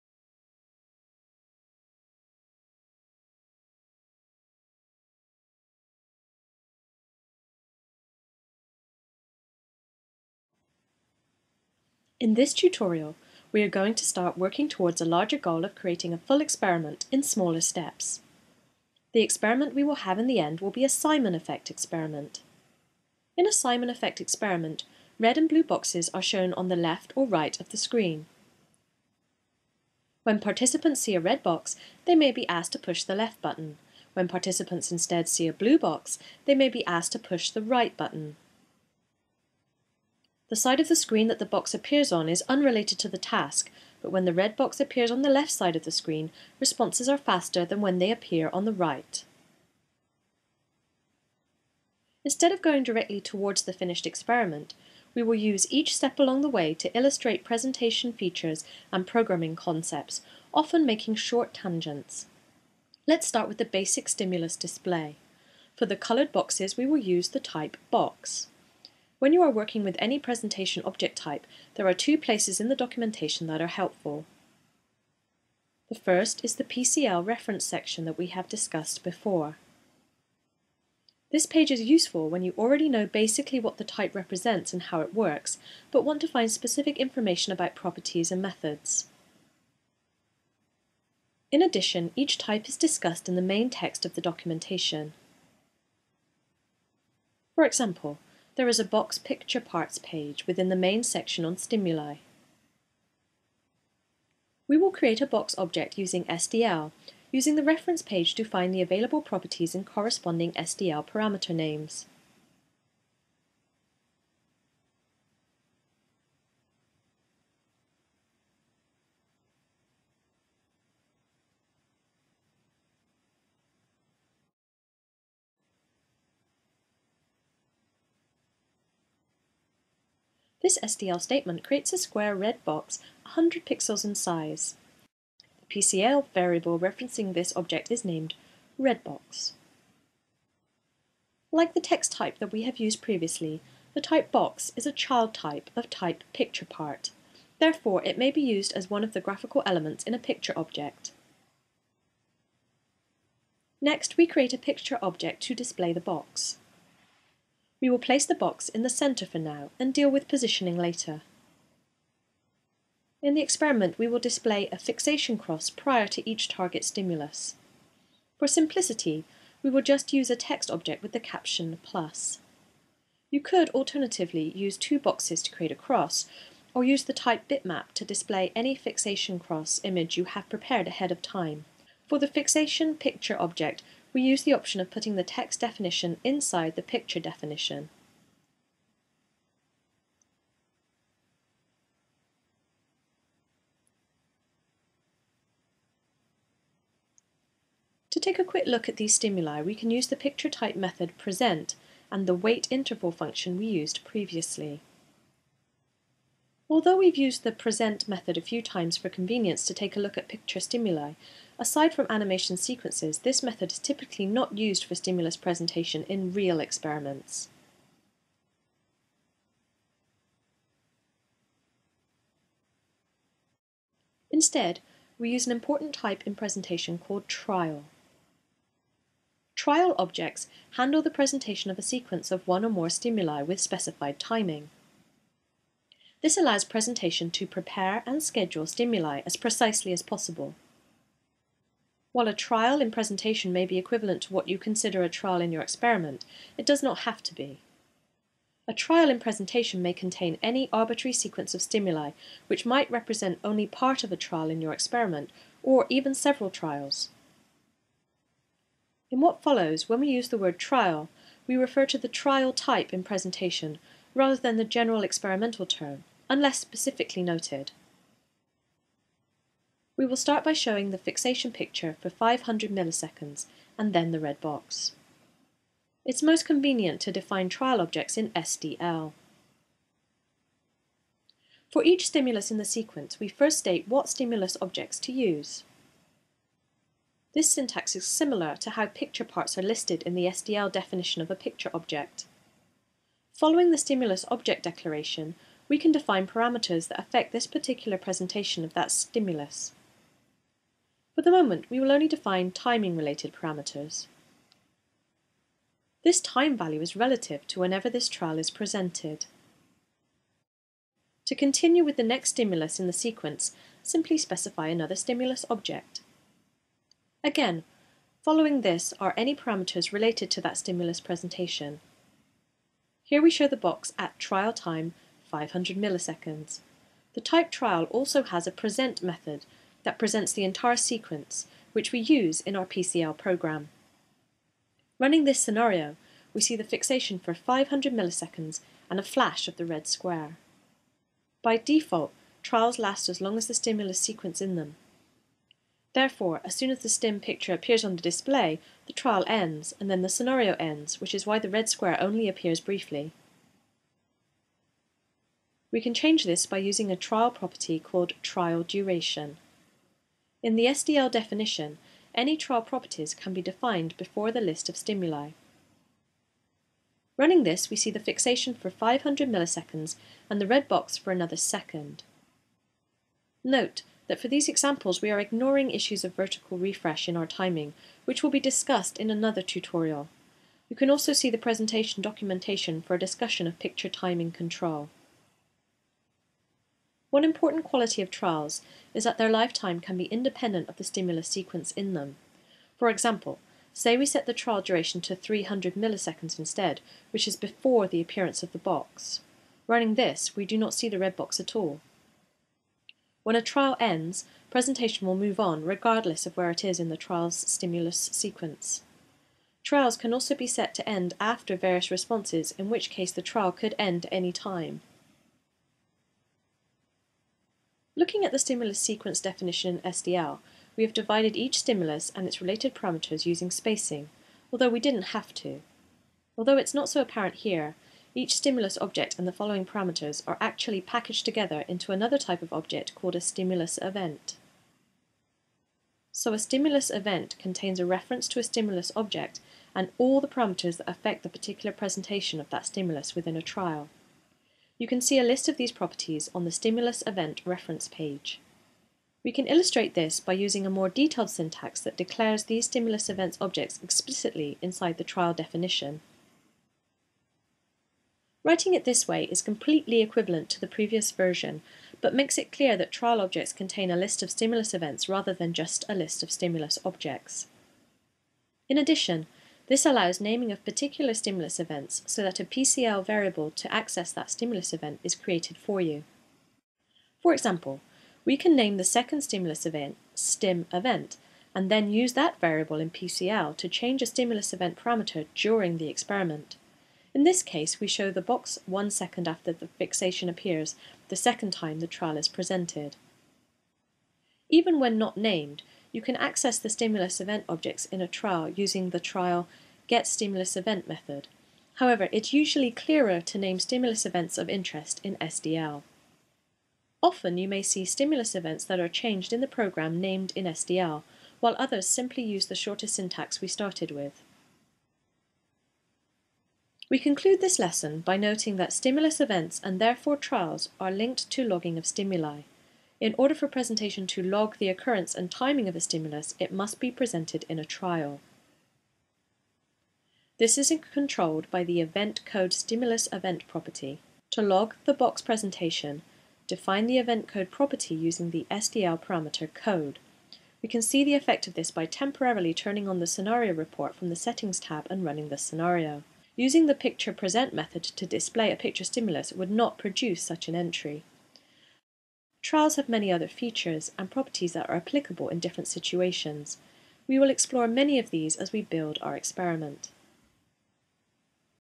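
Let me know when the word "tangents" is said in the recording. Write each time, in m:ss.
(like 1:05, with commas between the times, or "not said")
1:01.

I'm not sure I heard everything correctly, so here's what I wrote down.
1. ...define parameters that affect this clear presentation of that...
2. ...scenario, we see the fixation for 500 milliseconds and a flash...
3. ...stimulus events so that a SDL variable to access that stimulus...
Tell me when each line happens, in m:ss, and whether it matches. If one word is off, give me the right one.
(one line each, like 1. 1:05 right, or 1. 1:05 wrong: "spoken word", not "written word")
1. 4:55 wrong: "particular", not "clear"
2. 5:35 right
3. 7:51 wrong: "PCL", not "SDL".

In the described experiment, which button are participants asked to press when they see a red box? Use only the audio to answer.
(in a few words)
Left button.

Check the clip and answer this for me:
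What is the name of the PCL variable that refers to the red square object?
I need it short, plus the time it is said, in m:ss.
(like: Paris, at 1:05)
redbox, at 2:18.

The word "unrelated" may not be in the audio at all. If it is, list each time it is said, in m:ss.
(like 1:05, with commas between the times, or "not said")
0:42.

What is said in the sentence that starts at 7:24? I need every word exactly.
You can see a list of these properties on the stimulus event reference page.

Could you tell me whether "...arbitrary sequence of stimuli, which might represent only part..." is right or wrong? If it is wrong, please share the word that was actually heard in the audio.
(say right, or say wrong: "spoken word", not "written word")
right.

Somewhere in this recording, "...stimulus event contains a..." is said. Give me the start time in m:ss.
7:16.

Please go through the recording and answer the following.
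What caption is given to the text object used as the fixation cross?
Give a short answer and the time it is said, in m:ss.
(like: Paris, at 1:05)
plus, at 2:51.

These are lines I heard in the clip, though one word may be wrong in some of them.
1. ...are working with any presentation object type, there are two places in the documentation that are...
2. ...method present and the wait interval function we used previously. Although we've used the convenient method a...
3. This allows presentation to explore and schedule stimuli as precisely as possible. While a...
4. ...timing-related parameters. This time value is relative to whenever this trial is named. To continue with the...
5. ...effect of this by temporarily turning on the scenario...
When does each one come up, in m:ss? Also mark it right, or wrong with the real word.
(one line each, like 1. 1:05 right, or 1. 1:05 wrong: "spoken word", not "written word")
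1. 1:09 right
2. 3:20 wrong: "present", not "convenient"
3. 3:56 wrong: "prepare", not "explore"
4. 5:02 wrong: "presented", not "named"
5. 9:01 right.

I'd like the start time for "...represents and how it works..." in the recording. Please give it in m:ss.
1:24.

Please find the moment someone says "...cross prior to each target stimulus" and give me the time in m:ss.
2:45.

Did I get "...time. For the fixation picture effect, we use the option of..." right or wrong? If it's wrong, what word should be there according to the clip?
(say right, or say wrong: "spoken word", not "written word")
wrong: "object", not "effect".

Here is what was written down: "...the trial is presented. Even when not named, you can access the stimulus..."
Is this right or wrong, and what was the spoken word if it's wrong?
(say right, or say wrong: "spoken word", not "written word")
right.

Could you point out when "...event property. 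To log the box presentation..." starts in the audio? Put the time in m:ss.
8:53.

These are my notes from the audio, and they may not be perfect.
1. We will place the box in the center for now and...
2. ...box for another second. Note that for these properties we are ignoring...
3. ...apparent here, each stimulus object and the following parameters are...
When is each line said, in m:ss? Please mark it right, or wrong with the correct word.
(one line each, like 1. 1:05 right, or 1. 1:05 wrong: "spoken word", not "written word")
1. 2:37 right
2. 6:10 wrong: "examples", not "properties"
3. 7:07 right.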